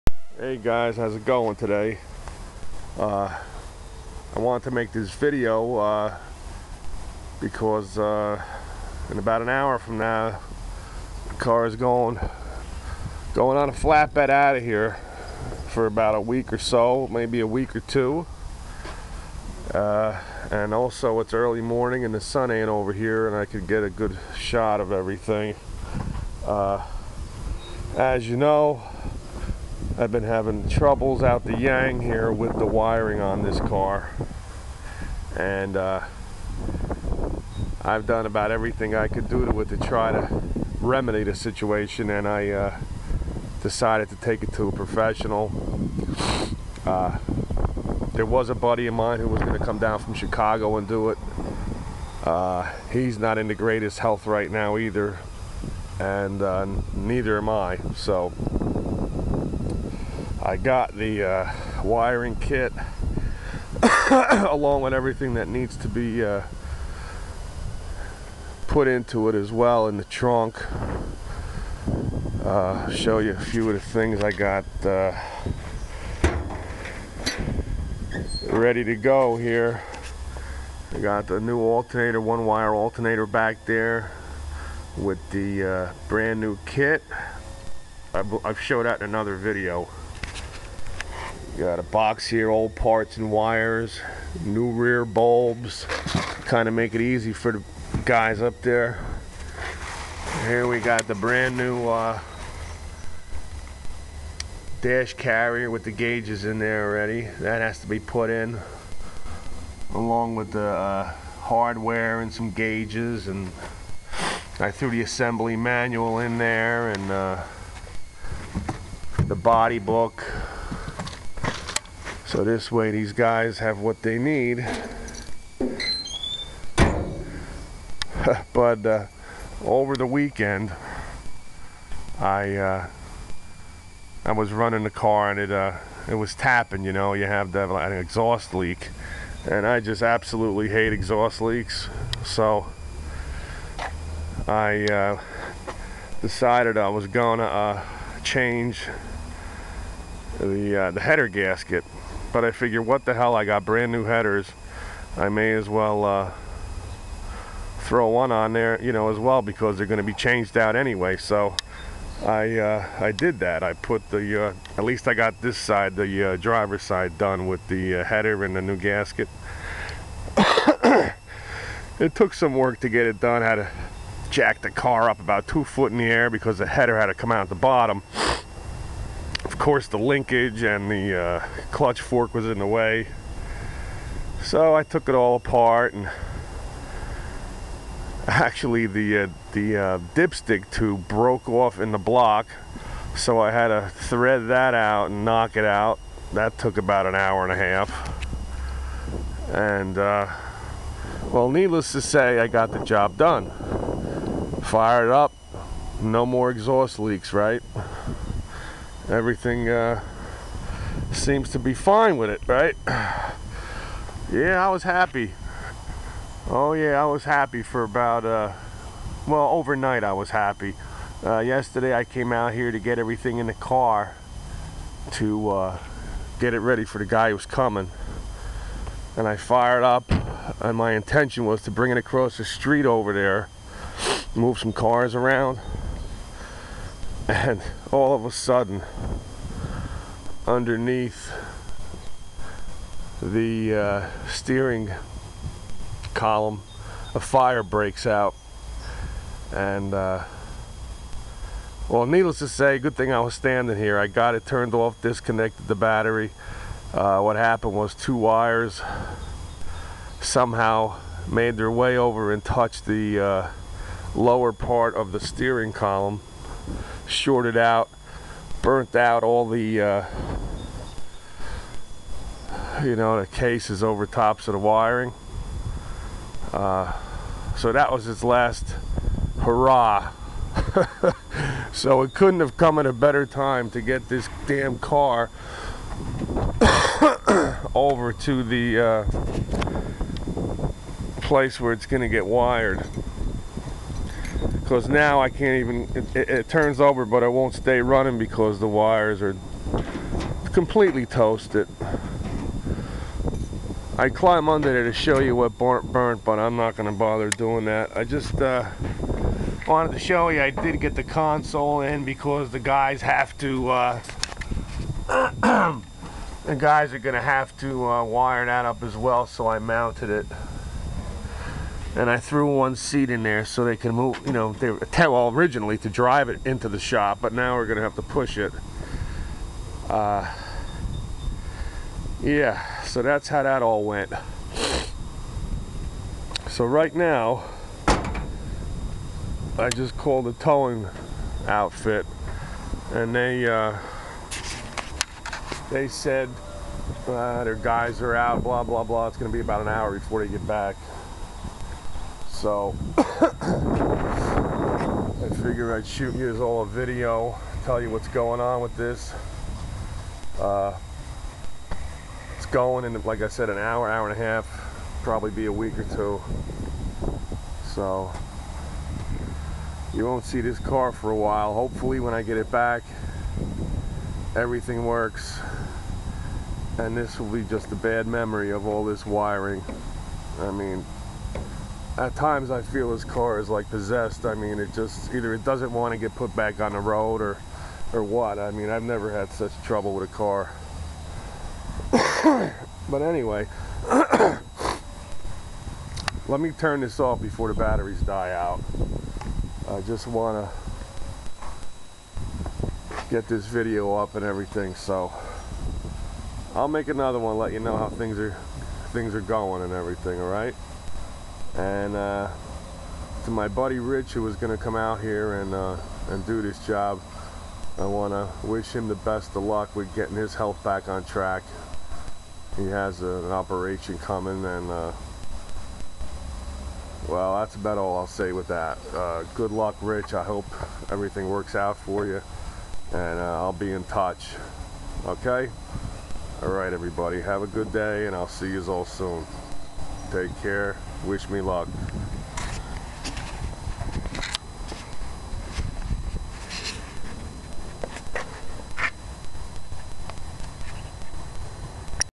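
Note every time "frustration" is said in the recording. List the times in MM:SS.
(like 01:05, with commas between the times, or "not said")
not said.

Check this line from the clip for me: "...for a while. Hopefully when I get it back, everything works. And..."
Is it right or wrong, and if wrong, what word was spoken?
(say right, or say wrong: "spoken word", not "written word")
right.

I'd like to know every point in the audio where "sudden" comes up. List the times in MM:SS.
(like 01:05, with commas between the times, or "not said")
03:58.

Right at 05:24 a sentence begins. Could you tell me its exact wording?
You know, they well originally to drive it into the shop, but now we're gonna have to push it.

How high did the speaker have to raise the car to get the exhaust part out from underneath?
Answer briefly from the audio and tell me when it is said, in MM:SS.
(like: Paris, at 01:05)
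2 feet, at 02:55.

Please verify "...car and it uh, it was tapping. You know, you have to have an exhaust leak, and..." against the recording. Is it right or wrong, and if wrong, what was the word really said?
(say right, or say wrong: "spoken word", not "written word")
right.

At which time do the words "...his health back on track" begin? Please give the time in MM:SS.
07:00.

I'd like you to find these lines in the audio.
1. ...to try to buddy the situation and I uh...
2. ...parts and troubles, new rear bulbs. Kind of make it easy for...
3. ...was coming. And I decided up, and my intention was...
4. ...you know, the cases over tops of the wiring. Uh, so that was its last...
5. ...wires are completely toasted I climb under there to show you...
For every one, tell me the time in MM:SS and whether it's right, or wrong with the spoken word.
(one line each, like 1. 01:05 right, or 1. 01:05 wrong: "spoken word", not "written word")
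1. 00:39 wrong: "remedy", not "buddy"
2. 01:32 wrong: "wires", not "troubles"
3. 03:47 wrong: "fired", not "decided"
4. 04:32 right
5. 04:58 right.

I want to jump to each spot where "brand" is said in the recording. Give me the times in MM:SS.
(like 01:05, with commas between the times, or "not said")
01:26, 01:41, 02:33.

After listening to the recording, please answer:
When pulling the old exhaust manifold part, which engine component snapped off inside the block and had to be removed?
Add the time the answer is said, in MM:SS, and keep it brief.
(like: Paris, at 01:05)
dipstick tube, at 03:10.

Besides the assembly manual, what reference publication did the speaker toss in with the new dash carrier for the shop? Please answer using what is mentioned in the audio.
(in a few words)
body book.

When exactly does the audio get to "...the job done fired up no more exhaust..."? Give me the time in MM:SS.
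03:22.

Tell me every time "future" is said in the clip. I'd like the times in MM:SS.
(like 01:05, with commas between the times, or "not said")
not said.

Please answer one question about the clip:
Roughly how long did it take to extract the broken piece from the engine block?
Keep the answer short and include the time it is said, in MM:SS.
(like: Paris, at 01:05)
an hour and a half, at 03:16.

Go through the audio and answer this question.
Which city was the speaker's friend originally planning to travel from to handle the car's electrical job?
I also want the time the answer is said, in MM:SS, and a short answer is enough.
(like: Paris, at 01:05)
Chicago, at 00:50.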